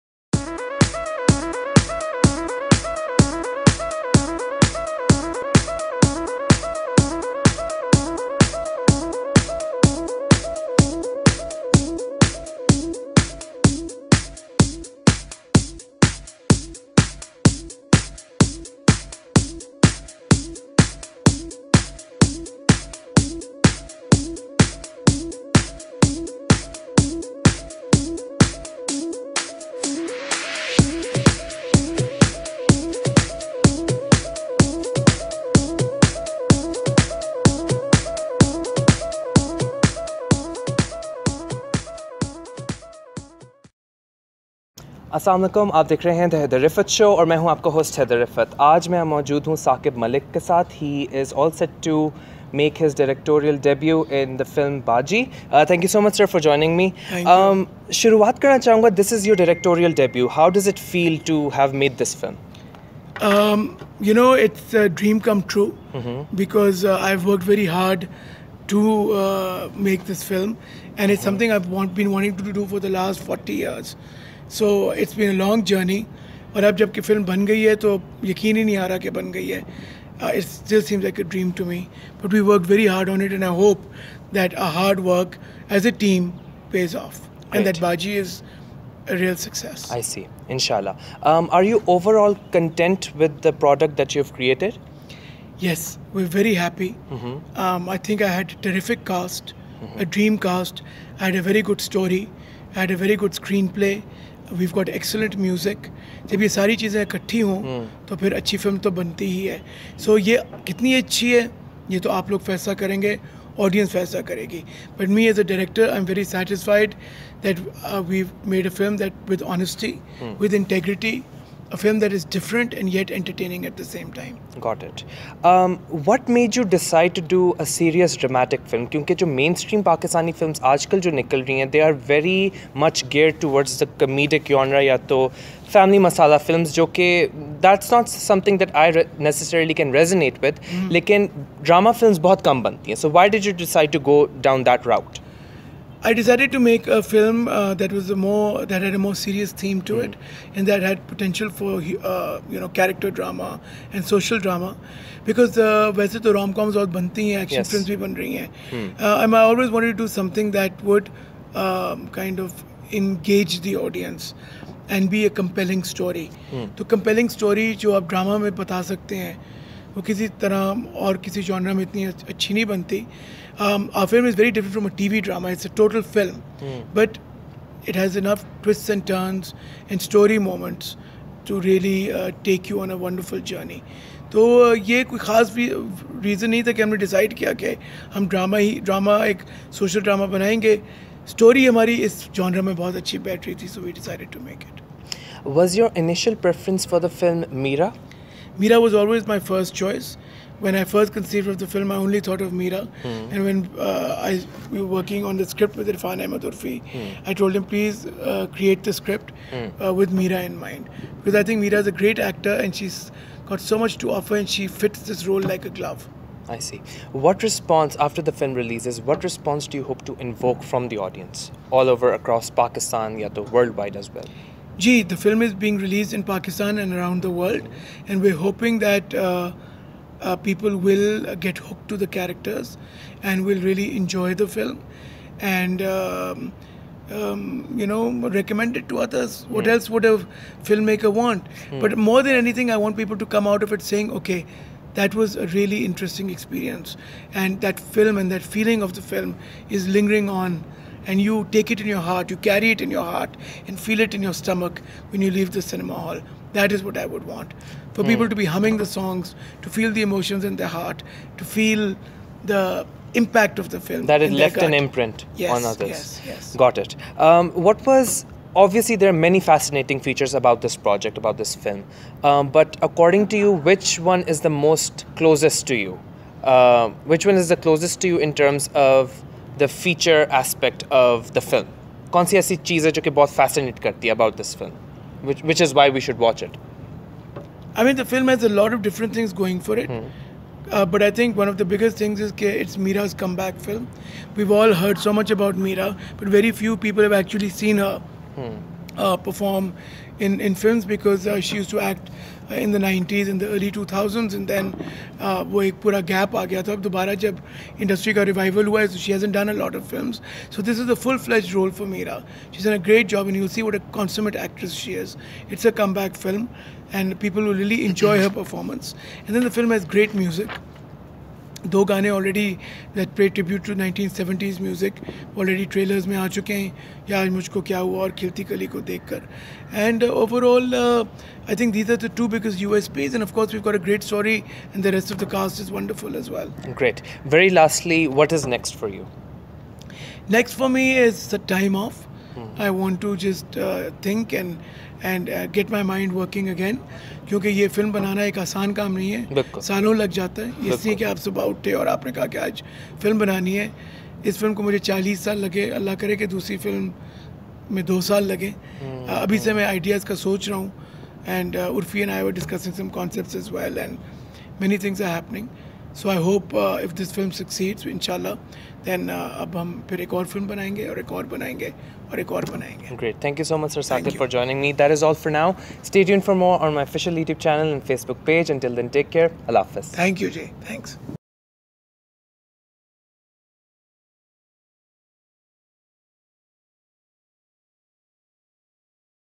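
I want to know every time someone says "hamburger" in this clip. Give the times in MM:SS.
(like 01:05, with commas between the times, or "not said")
not said.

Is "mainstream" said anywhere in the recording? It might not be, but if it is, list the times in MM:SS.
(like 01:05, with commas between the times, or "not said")
02:09.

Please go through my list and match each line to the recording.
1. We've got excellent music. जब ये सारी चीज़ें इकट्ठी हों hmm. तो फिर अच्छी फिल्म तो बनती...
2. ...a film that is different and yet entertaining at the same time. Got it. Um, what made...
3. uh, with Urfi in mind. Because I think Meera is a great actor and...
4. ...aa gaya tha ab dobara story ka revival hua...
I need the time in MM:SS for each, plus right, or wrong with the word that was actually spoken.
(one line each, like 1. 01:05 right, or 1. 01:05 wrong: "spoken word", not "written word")
1. 01:44 right
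2. 02:01 right
3. 03:29 wrong: "Meera", not "Urfi"
4. 05:06 wrong: "industry", not "story".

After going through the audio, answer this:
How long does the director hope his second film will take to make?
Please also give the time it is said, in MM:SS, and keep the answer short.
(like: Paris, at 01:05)
2 years, at 05:57.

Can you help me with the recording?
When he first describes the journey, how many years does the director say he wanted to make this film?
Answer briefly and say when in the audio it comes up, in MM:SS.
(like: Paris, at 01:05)
40, at 01:13.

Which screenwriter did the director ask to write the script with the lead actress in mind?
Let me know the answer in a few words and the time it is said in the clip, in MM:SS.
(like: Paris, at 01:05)
Irfan Ahmed Urfi, at 03:25.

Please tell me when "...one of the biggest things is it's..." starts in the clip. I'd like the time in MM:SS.
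04:51.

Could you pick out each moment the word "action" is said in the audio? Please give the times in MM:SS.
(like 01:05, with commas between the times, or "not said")
02:37.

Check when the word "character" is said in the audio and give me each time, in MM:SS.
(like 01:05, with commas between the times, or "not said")
02:32, 03:52.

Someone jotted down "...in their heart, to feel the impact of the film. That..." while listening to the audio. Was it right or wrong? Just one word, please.
right.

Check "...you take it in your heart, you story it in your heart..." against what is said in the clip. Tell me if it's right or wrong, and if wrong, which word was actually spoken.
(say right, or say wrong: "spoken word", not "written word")
wrong: "carry", not "story".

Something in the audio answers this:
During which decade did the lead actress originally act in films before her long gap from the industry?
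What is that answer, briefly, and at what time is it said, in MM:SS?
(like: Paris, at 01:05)
1990s, at 05:02.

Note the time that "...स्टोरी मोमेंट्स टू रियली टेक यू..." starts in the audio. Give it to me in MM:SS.
03:00.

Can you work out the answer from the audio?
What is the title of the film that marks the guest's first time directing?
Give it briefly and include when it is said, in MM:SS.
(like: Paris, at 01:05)
Baaji, at 00:54.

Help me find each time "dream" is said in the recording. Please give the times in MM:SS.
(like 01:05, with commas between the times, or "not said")
01:40.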